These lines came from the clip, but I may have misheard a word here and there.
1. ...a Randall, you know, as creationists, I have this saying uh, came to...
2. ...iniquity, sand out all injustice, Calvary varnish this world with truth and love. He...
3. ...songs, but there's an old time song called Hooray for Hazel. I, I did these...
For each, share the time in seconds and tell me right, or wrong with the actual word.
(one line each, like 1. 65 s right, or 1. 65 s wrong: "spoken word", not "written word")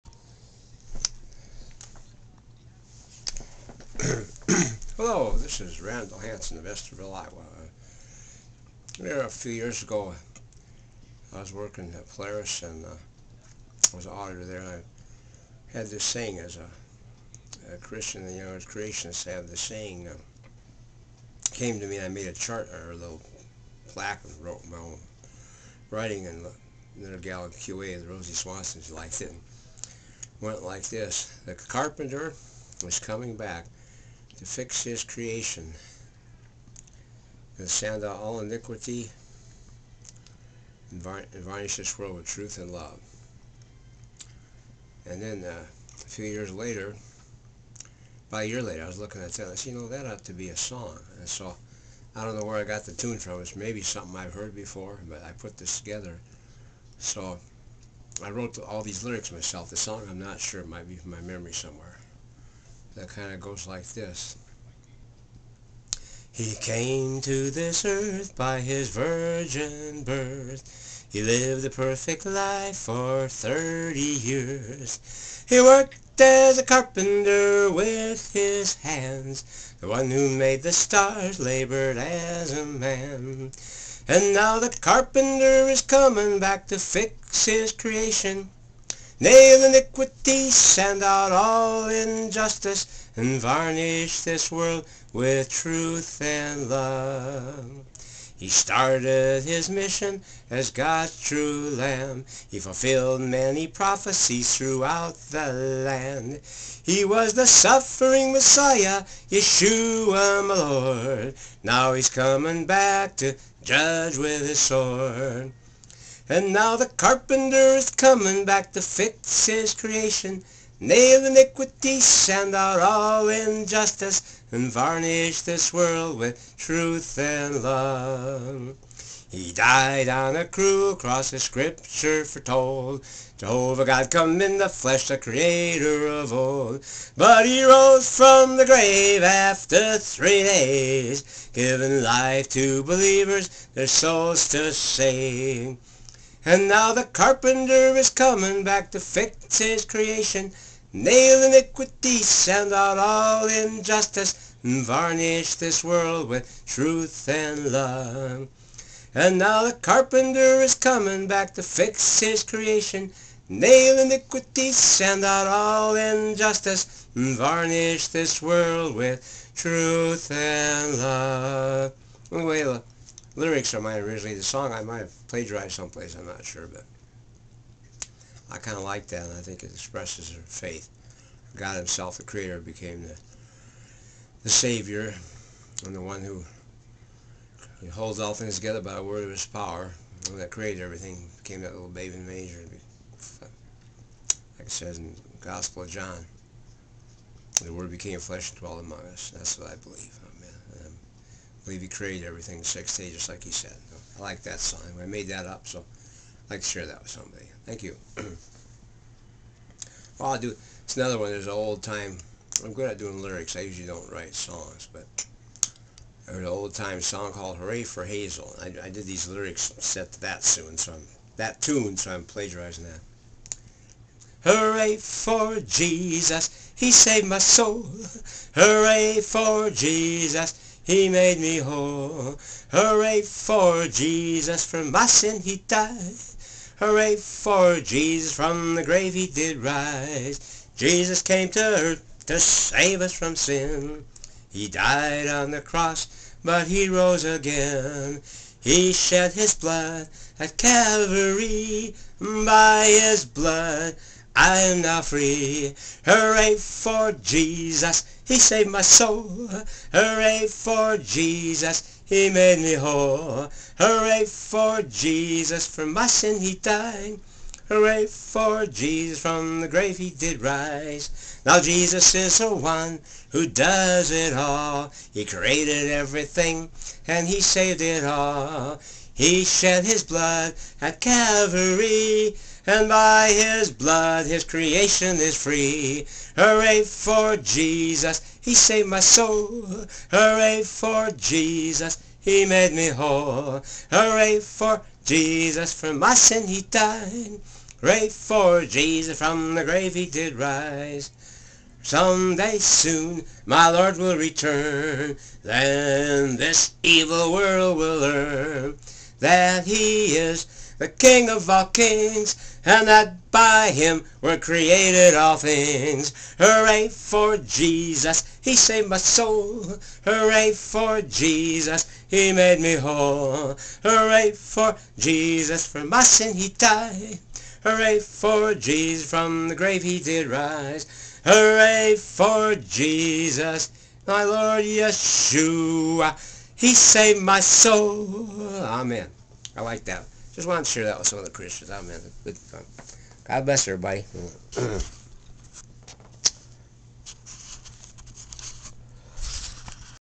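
1. 17 s wrong: "Christian", not "Randall"
2. 121 s wrong: "And", not "Calvary"
3. 214 s right.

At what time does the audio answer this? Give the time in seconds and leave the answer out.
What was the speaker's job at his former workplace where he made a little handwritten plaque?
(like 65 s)
14 s.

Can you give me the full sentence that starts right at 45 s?
And then uh, a few years later, about a year later, I was looking at that.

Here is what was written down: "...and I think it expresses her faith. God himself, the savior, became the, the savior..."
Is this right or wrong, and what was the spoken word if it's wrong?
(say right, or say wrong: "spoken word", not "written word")
wrong: "creator", not "savior".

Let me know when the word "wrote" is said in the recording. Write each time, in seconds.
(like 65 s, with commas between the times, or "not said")
24 s, 58 s.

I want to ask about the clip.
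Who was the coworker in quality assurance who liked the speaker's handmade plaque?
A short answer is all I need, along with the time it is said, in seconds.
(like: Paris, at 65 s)
Rosie Swanson, at 28 s.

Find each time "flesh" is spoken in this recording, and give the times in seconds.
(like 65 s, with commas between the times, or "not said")
134 s, 198 s.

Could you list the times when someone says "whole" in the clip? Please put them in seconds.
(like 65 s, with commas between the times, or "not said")
231 s, 262 s, 292 s, 322 s.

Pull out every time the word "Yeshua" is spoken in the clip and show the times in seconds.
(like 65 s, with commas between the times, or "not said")
109 s, 334 s.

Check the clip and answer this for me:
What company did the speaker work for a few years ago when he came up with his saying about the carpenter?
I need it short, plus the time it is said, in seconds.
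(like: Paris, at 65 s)
Polaris, at 12 s.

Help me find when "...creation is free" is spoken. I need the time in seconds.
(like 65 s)
284 s.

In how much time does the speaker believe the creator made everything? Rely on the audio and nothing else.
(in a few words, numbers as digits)
6 days.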